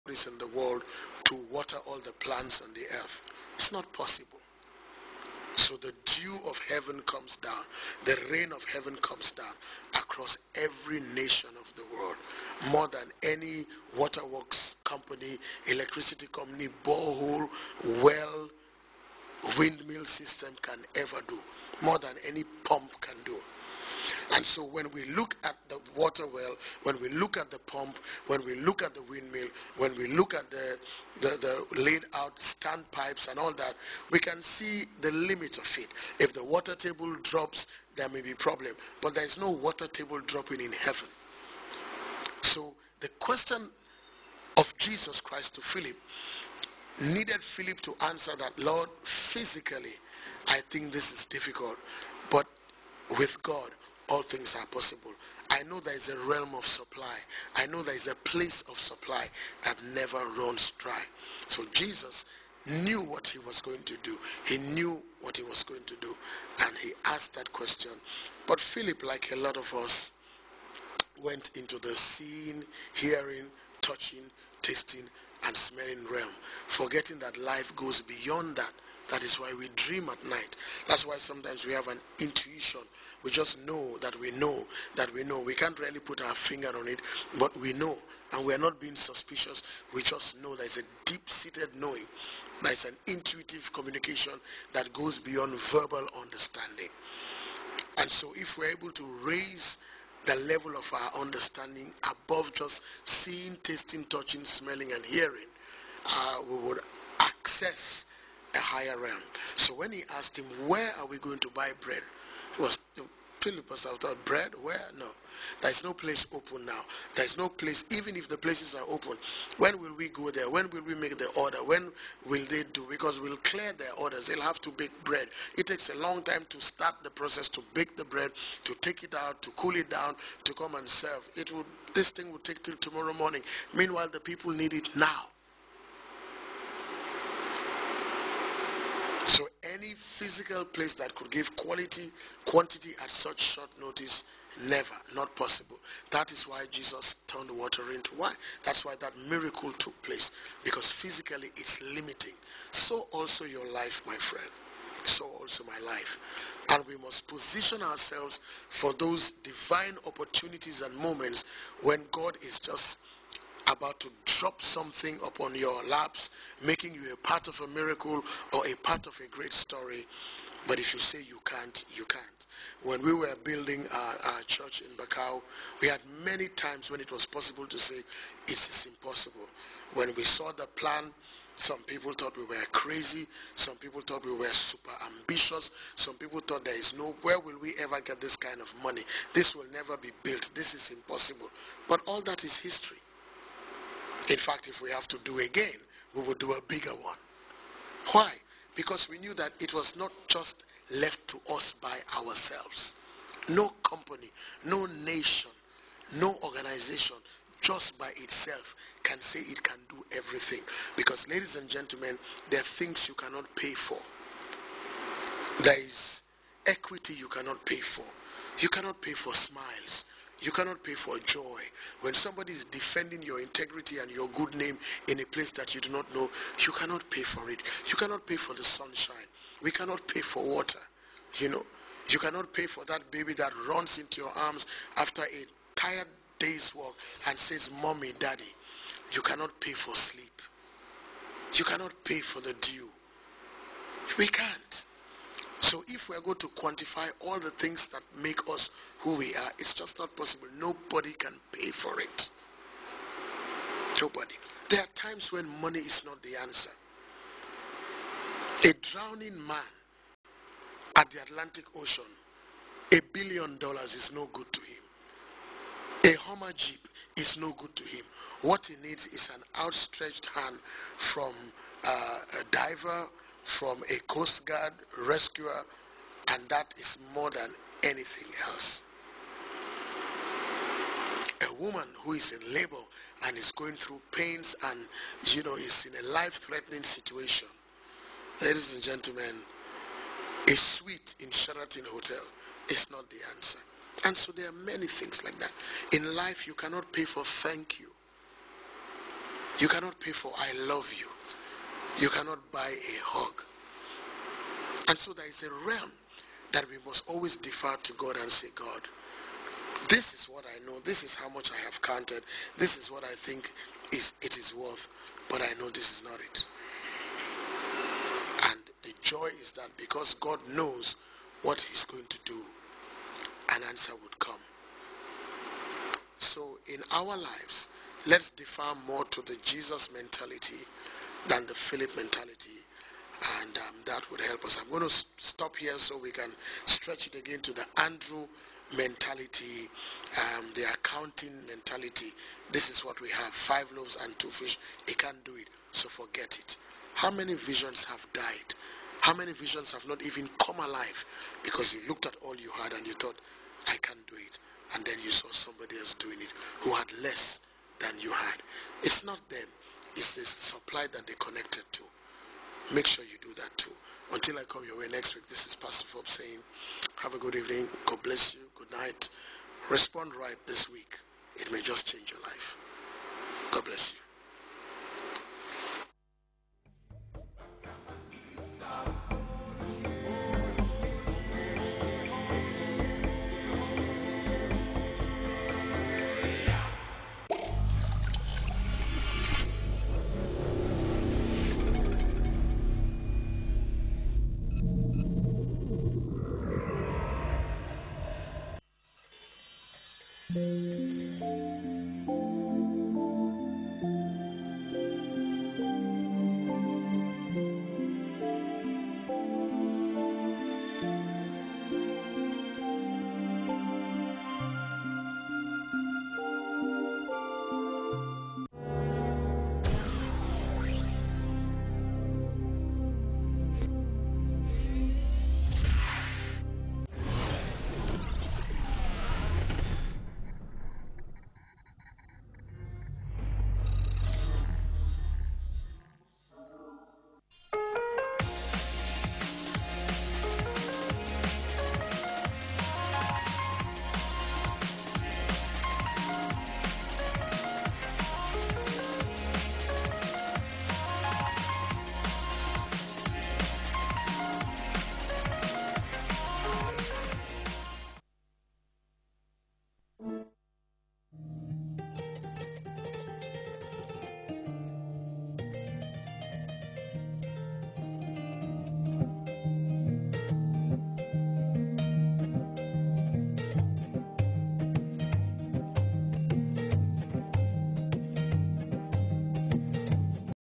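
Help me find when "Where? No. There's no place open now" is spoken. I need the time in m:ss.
1:54.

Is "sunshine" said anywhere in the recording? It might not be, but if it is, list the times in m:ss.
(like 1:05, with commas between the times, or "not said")
3:48.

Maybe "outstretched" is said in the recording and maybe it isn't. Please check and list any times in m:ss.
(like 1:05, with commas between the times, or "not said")
4:29.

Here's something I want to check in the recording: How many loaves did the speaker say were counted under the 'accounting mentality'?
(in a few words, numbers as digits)
5.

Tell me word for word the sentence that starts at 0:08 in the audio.
The rain of heaven comes down across every nation of the world.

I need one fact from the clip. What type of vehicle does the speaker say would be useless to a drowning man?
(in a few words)
Hummer Jeep.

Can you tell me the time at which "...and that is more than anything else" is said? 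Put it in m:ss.
4:36.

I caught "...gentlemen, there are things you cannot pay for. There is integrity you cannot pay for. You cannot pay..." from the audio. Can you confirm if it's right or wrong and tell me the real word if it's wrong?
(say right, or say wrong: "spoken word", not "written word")
wrong: "equity", not "integrity".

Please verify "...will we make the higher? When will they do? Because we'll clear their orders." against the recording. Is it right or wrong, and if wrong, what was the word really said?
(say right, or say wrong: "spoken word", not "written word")
wrong: "order", not "higher".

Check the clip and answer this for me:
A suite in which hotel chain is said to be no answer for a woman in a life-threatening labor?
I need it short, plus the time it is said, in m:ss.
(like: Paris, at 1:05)
Sheraton, at 4:51.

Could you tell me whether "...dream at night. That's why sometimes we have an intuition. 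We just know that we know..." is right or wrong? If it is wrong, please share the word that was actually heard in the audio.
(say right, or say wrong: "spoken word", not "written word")
right.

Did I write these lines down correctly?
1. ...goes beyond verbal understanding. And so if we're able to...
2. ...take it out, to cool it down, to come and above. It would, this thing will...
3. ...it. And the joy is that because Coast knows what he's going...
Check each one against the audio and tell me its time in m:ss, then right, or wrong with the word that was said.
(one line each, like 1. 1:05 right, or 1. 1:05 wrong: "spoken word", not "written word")
1. 1:34 right
2. 2:08 wrong: "serve", not "above"
3. 5:16 wrong: "God", not "Coast".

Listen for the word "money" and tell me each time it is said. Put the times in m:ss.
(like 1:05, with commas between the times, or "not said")
3:08, 4:15.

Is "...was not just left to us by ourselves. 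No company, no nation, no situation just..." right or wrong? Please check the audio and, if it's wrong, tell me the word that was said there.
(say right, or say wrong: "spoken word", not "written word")
wrong: "organization", not "situation".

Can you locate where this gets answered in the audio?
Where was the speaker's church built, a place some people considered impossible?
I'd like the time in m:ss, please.
2:54.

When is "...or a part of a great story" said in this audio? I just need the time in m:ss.
2:48.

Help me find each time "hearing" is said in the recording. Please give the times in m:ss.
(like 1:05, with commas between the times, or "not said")
1:12, 1:45.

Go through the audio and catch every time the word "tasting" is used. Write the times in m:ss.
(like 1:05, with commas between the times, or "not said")
1:14, 1:43.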